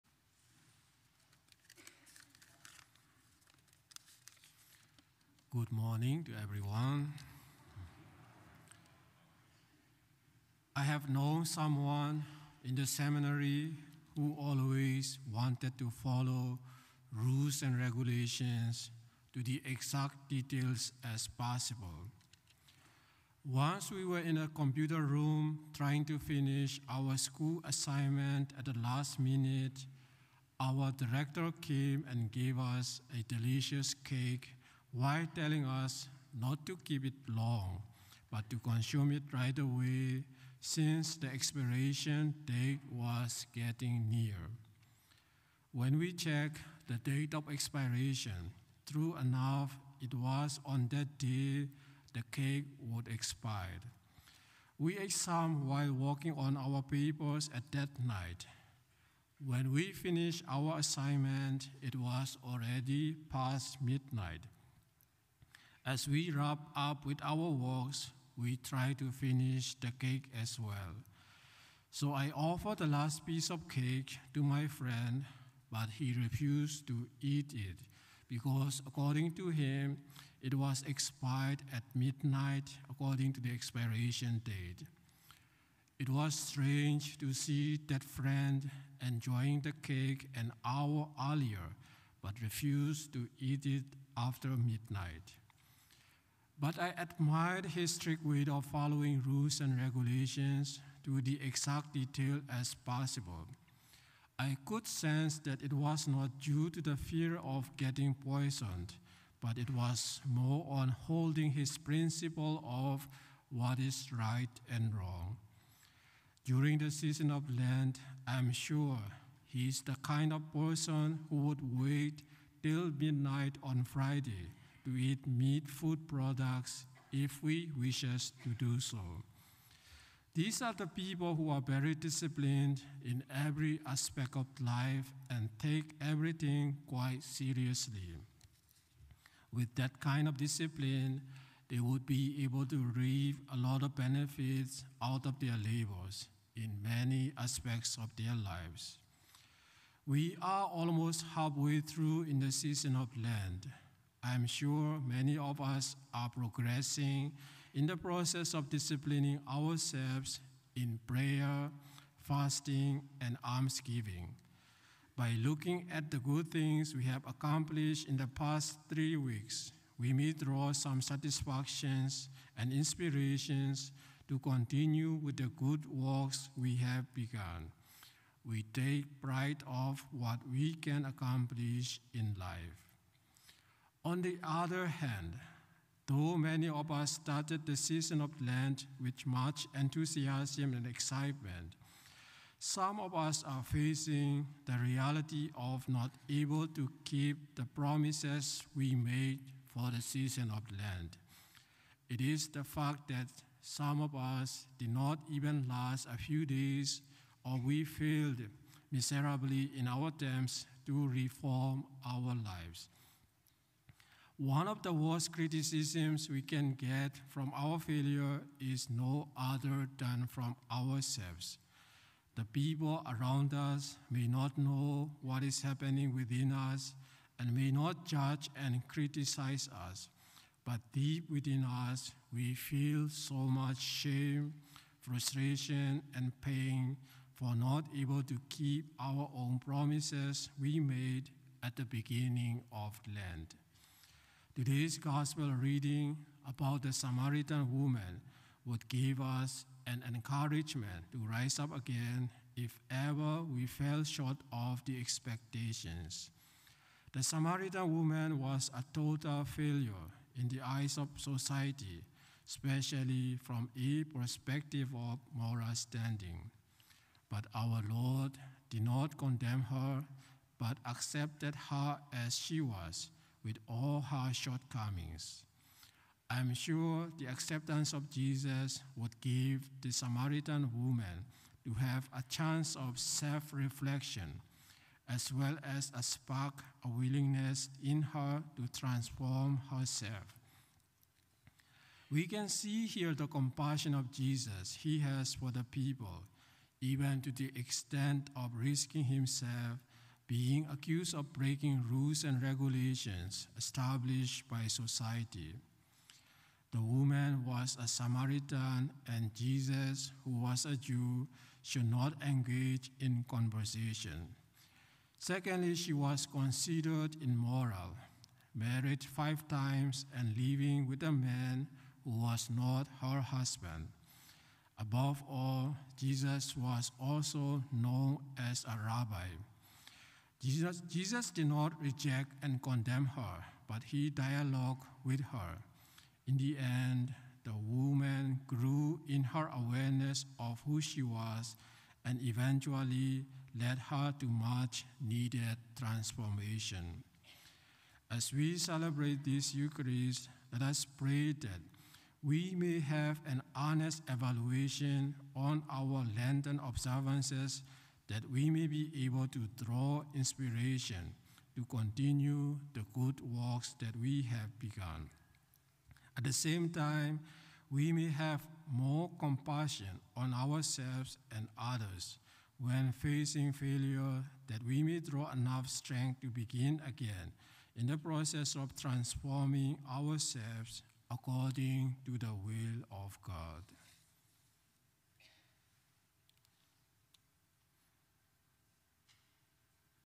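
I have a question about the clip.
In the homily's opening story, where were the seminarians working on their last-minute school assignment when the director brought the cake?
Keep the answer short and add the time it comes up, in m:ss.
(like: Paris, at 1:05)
Computer room, at 0:24.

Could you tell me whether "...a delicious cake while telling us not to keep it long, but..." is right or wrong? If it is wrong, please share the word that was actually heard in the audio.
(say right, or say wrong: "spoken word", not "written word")
right.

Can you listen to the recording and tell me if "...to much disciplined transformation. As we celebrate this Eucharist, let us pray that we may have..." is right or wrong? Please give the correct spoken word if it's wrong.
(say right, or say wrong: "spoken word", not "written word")
wrong: "needed", not "disciplined".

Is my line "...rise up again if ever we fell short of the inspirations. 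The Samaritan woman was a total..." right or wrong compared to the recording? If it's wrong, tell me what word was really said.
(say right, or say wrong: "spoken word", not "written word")
wrong: "expectations", not "inspirations".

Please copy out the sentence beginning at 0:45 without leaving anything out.
When we checked the date of expiration, true enough, it was on that day the cake would expire.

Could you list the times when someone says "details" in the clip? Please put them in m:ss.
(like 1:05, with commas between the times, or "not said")
0:20, 1:41.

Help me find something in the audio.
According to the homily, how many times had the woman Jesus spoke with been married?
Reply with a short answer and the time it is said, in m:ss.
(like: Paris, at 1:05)
5, at 5:19.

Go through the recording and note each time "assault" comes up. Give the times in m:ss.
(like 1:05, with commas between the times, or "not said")
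not said.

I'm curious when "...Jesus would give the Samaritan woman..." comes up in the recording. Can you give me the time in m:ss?
4:38.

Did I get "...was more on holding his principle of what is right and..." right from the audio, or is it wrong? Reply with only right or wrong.
right.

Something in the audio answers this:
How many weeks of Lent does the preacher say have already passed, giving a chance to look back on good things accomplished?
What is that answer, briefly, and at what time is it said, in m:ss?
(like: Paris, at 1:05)
3, at 2:48.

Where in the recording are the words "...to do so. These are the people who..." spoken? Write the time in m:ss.
2:08.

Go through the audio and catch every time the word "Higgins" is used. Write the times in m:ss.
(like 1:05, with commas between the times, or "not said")
not said.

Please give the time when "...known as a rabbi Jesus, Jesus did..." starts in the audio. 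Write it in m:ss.
5:27.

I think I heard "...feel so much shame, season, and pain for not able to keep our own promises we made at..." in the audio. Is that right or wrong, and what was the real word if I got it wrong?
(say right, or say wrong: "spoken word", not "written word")
wrong: "frustration", not "season".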